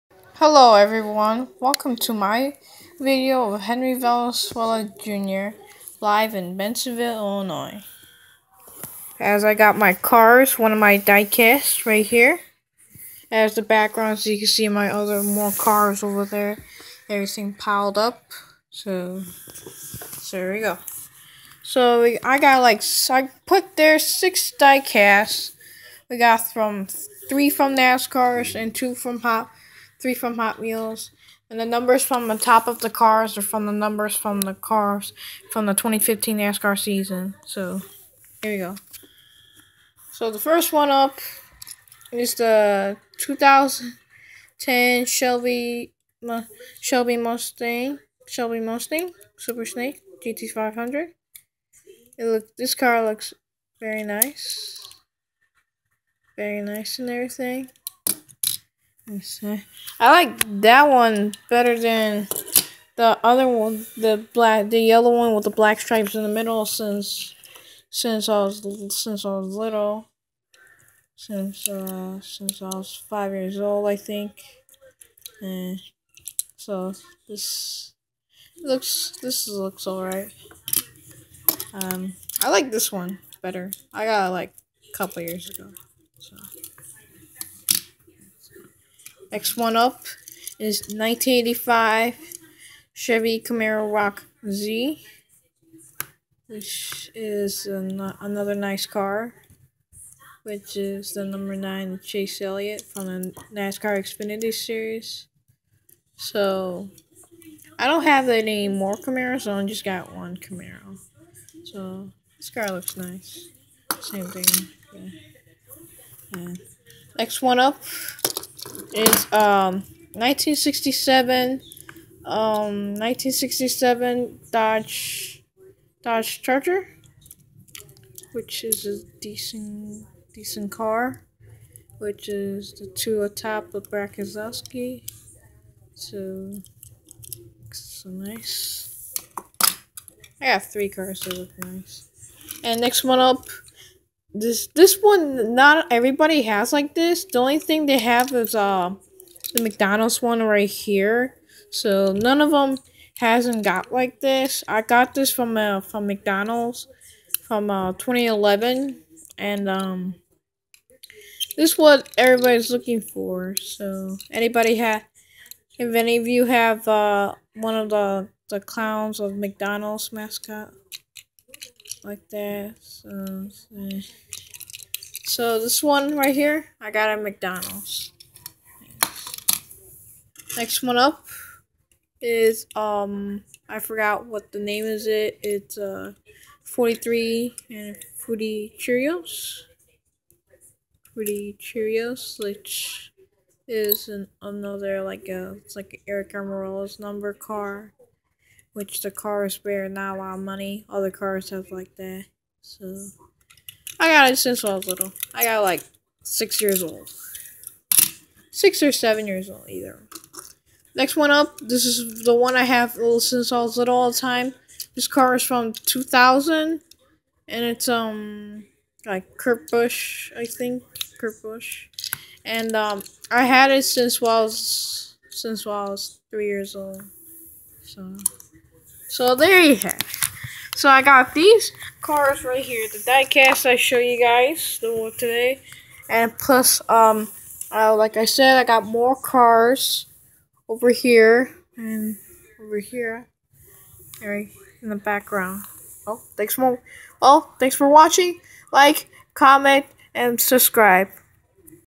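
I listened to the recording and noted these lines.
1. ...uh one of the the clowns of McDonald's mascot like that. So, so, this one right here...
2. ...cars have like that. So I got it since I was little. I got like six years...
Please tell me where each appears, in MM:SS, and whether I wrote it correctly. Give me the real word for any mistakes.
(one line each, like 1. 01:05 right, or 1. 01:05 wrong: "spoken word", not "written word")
1. 02:46 right
2. 03:21 right.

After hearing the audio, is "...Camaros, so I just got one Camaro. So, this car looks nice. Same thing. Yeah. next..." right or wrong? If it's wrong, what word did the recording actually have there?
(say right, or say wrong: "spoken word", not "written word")
right.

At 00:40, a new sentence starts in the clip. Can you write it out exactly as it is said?
So the first one up is the 2010 Shelby Shelby Mustang Shelby Mustang Super Snake GT500.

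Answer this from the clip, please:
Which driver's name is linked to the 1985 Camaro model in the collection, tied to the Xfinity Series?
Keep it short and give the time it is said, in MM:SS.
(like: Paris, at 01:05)
Chase Elliott, at 01:42.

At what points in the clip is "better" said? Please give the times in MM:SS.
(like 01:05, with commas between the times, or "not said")
01:01, 01:23.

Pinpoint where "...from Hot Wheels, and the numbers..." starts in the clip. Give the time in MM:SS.
00:30.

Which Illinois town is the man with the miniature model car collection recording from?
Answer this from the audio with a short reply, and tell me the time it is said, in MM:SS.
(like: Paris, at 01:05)
Bensenville, at 00:06.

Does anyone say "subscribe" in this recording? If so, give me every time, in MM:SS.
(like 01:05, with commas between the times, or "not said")
04:10.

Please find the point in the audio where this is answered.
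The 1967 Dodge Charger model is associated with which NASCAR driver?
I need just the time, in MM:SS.
02:13.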